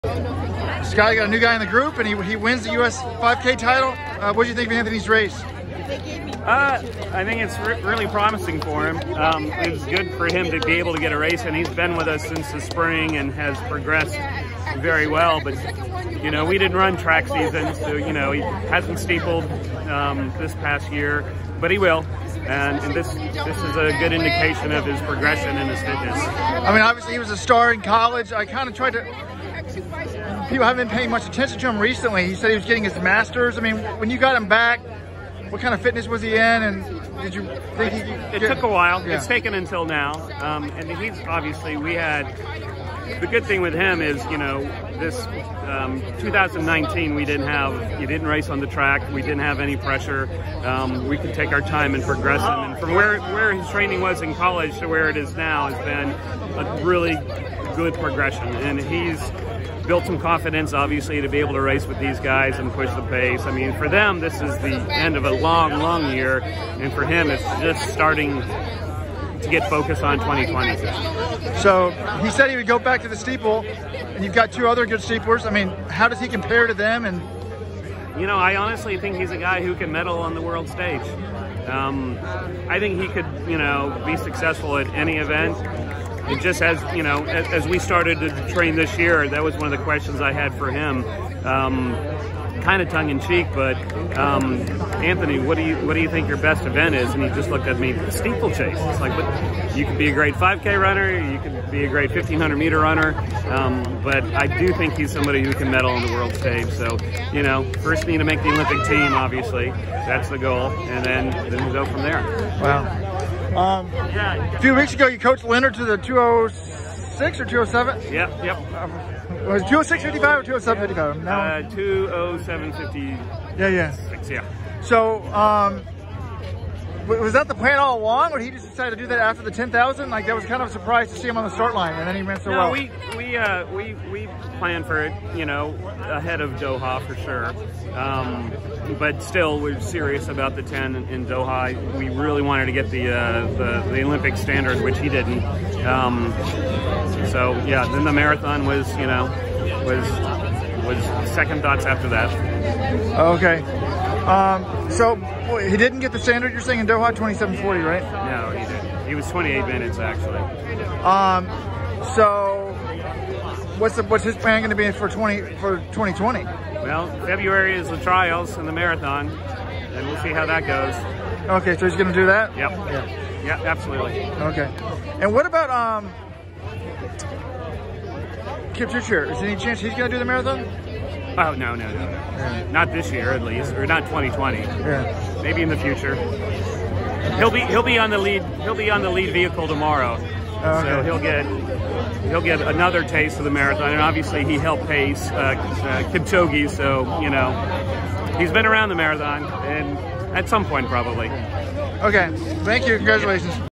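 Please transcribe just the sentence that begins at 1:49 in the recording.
That's the goal, and then then we go from there.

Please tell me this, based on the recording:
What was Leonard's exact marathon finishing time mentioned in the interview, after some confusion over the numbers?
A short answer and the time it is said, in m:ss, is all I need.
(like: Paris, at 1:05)
2:07:56, at 2:01.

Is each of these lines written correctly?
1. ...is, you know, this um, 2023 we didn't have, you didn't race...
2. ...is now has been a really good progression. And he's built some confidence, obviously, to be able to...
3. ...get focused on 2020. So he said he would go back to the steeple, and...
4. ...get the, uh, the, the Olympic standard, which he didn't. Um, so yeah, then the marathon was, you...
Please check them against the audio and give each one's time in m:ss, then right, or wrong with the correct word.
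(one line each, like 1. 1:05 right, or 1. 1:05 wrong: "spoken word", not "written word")
1. 0:44 wrong: "2019", not "2023"
2. 0:55 right
3. 1:09 right
4. 2:22 right.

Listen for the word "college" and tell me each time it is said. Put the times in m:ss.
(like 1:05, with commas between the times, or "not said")
0:27, 0:54.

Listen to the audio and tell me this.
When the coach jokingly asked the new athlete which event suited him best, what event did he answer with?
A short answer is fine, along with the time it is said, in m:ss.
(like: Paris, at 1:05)
Steeplechase, at 1:38.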